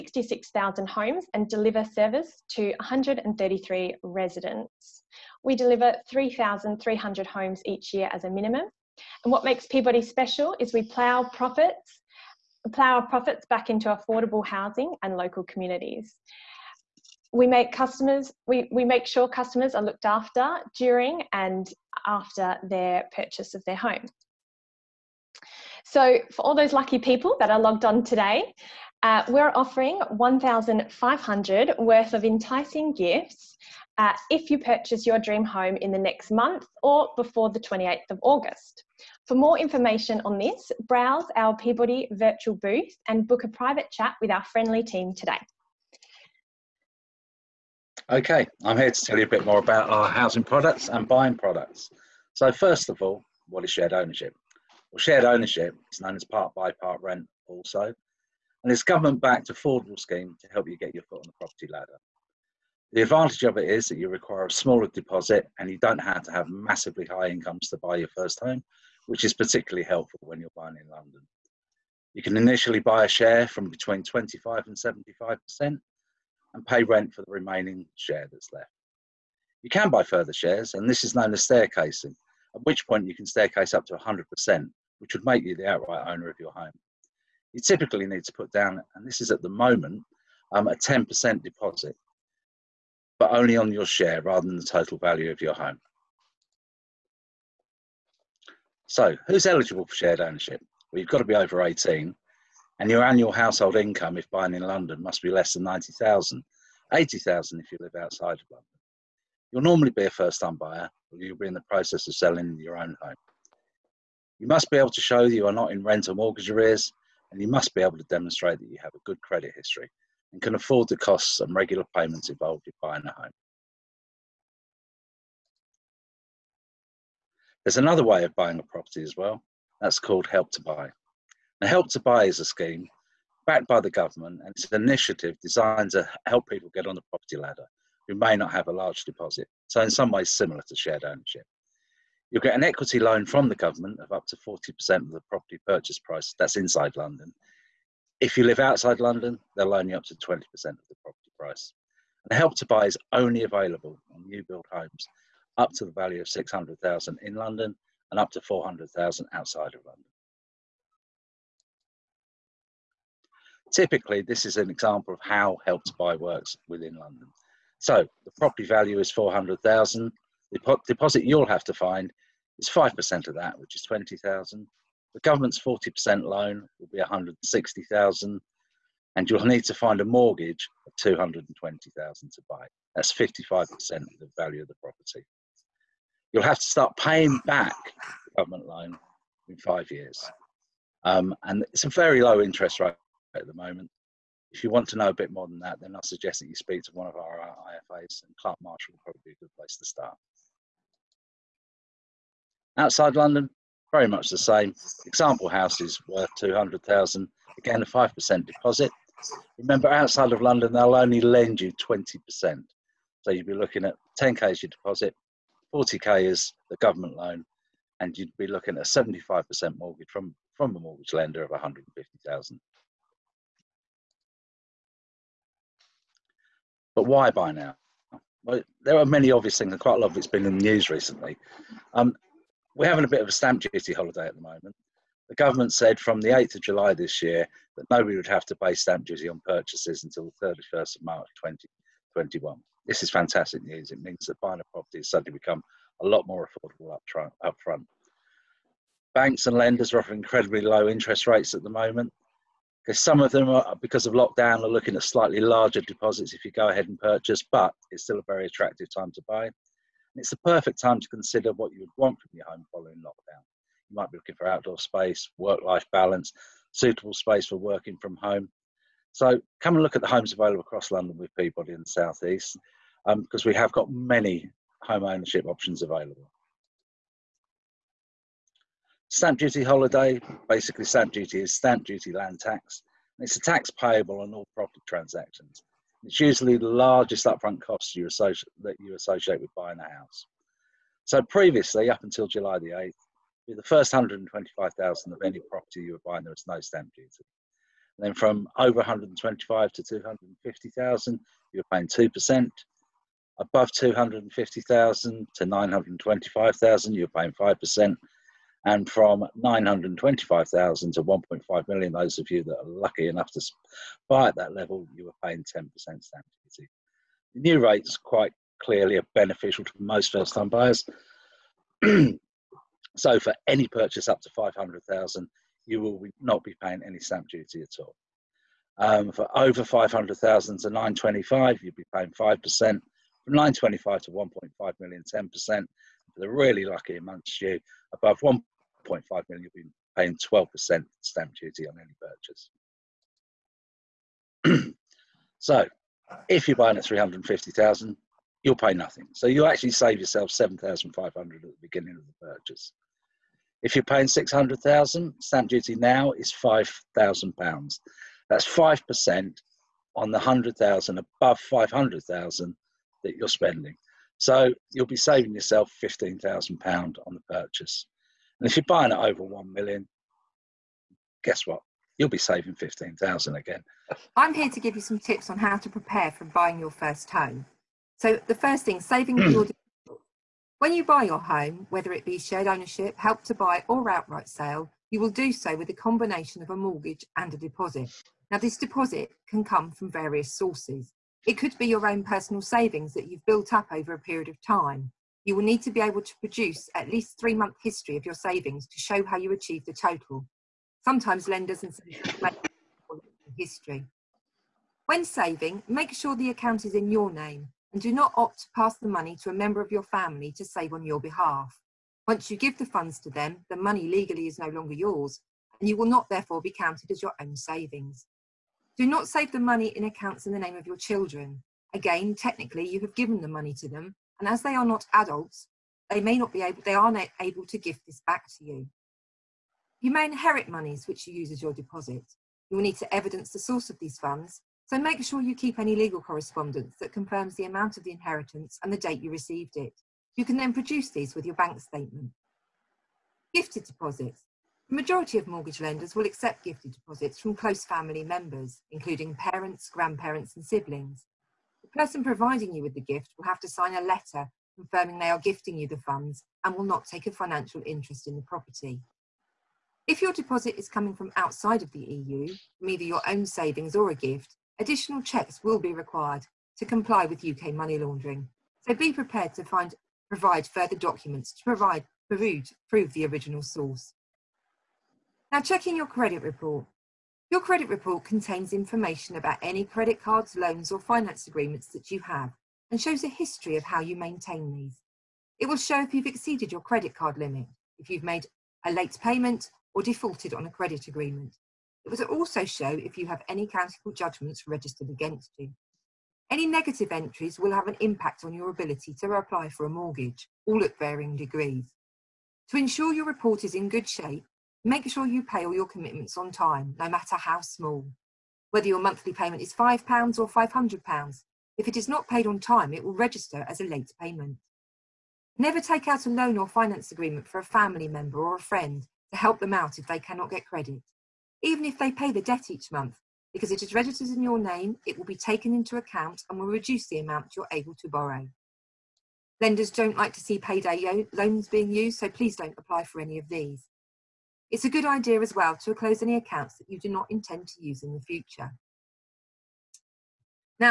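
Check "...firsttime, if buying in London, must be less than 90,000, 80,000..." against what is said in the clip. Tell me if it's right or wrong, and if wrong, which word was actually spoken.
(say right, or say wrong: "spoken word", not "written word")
wrong: "income", not "firsttime".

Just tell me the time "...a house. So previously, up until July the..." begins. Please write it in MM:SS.
04:49.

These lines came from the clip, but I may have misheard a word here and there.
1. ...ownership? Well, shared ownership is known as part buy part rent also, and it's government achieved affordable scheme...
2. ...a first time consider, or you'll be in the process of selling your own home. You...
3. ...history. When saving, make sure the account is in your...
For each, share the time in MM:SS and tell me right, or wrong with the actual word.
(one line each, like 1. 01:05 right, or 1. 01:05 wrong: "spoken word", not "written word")
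1. 00:53 wrong: "backed", not "achieved"
2. 01:50 wrong: "buyer", not "consider"
3. 06:43 right.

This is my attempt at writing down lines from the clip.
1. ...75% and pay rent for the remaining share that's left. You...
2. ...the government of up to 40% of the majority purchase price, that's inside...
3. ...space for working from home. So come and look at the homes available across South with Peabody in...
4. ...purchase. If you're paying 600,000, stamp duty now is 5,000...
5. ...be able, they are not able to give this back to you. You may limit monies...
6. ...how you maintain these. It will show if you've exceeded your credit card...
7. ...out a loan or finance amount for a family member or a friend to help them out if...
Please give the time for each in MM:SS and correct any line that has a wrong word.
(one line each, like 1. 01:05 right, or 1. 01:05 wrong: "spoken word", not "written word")
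1. 01:14 right
2. 02:23 wrong: "property", not "majority"
3. 04:27 wrong: "London", not "South"
4. 05:52 right
5. 07:06 wrong: "inherit", not "limit"
6. 08:03 right
7. 08:35 wrong: "agreement", not "amount".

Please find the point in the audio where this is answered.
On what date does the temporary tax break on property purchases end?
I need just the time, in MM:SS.
04:00.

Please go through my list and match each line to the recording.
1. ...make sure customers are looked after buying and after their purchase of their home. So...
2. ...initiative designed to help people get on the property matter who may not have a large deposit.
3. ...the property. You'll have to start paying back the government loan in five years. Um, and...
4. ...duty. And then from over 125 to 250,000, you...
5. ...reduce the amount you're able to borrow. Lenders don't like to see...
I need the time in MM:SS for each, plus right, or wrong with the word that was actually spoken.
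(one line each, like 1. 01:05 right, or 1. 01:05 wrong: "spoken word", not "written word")
1. 00:18 wrong: "during", not "buying"
2. 02:14 wrong: "ladder", not "matter"
3. 03:04 right
4. 04:56 right
5. 08:46 right.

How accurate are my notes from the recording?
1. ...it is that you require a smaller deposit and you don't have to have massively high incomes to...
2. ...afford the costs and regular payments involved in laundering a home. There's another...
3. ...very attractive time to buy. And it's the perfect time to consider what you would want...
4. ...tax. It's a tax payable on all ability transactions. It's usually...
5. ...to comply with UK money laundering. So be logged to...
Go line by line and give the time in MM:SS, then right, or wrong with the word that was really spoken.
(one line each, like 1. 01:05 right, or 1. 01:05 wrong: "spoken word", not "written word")
1. 01:03 right
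2. 02:00 wrong: "buying", not "laundering"
3. 04:18 right
4. 04:42 wrong: "property", not "ability"
5. 07:46 wrong: "prepared", not "logged".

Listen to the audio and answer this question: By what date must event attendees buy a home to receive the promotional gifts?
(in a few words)
28th of August.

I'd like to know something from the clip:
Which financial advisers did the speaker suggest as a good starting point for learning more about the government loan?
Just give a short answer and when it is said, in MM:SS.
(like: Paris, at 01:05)
Clark Marshall, at 03:18.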